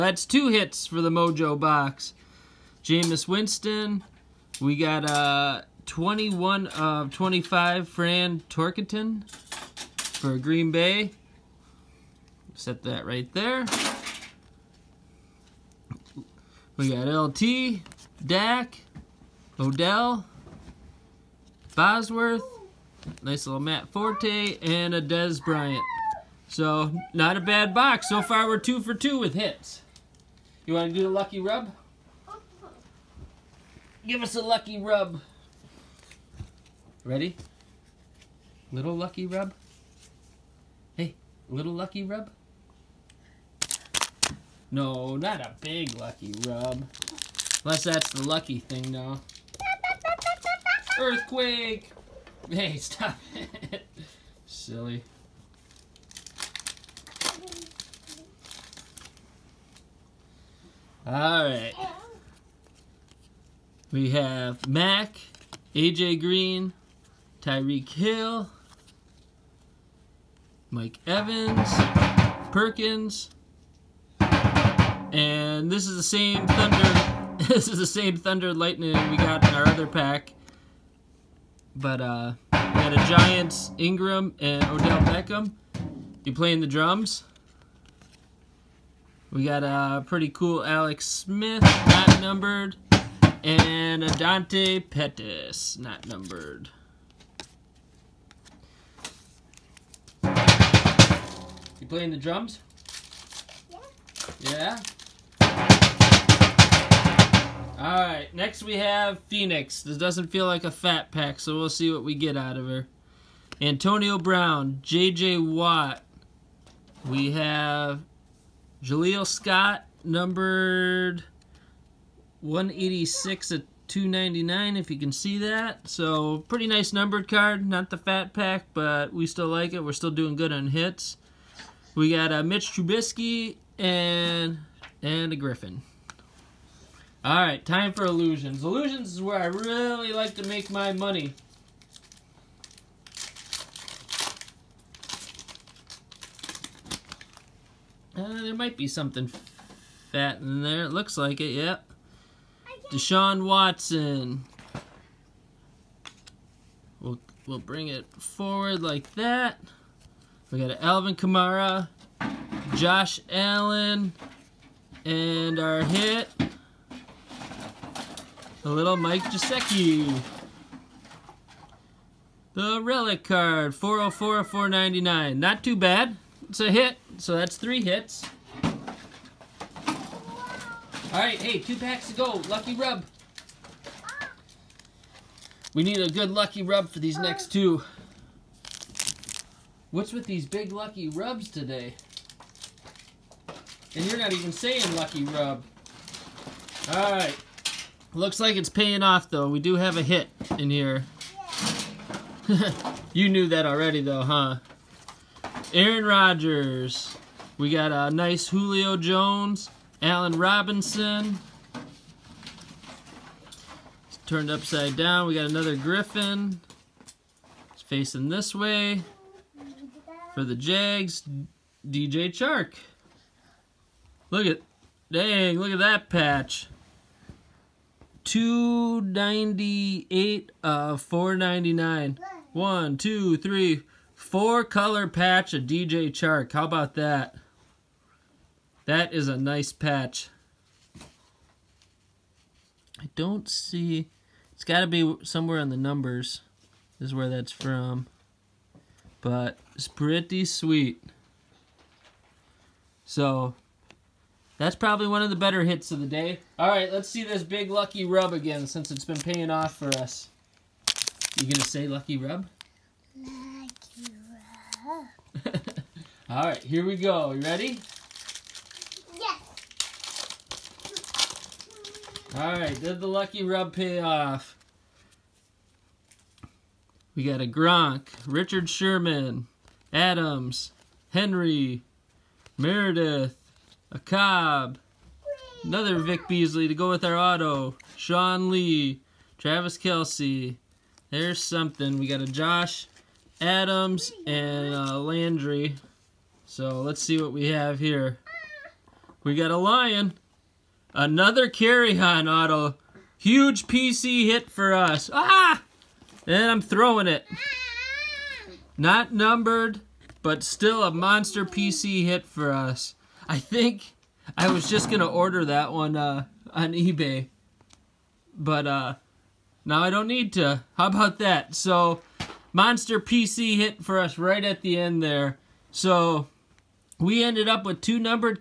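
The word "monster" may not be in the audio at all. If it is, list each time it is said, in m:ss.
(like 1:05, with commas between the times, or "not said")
5:10, 5:22.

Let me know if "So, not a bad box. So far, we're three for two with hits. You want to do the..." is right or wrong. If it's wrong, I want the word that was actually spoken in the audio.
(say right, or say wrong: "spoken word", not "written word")
wrong: "two", not "three".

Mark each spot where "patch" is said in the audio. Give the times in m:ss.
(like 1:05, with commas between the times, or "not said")
3:46, 3:55, 3:59.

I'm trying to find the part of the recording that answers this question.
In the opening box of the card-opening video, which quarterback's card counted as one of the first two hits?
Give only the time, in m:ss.
0:02.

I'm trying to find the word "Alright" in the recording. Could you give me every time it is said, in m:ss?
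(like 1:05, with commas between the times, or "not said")
1:01, 1:47, 2:17.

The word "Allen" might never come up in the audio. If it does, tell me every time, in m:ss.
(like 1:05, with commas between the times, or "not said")
2:43, 3:30.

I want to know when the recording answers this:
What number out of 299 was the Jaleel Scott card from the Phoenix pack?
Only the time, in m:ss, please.
2:02.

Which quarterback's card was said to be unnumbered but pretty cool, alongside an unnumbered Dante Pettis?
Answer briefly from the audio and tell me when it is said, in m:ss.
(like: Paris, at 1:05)
Alex Smith, at 1:30.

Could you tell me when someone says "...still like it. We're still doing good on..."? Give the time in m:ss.
2:09.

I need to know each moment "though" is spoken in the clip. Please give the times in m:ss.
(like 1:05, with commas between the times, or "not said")
3:19, 3:24.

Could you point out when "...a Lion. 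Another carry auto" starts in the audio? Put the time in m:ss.
4:59.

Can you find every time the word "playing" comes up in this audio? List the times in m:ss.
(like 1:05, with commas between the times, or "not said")
1:26, 1:41.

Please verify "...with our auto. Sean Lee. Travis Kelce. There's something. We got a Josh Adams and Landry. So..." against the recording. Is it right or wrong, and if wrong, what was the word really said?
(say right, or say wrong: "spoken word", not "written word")
right.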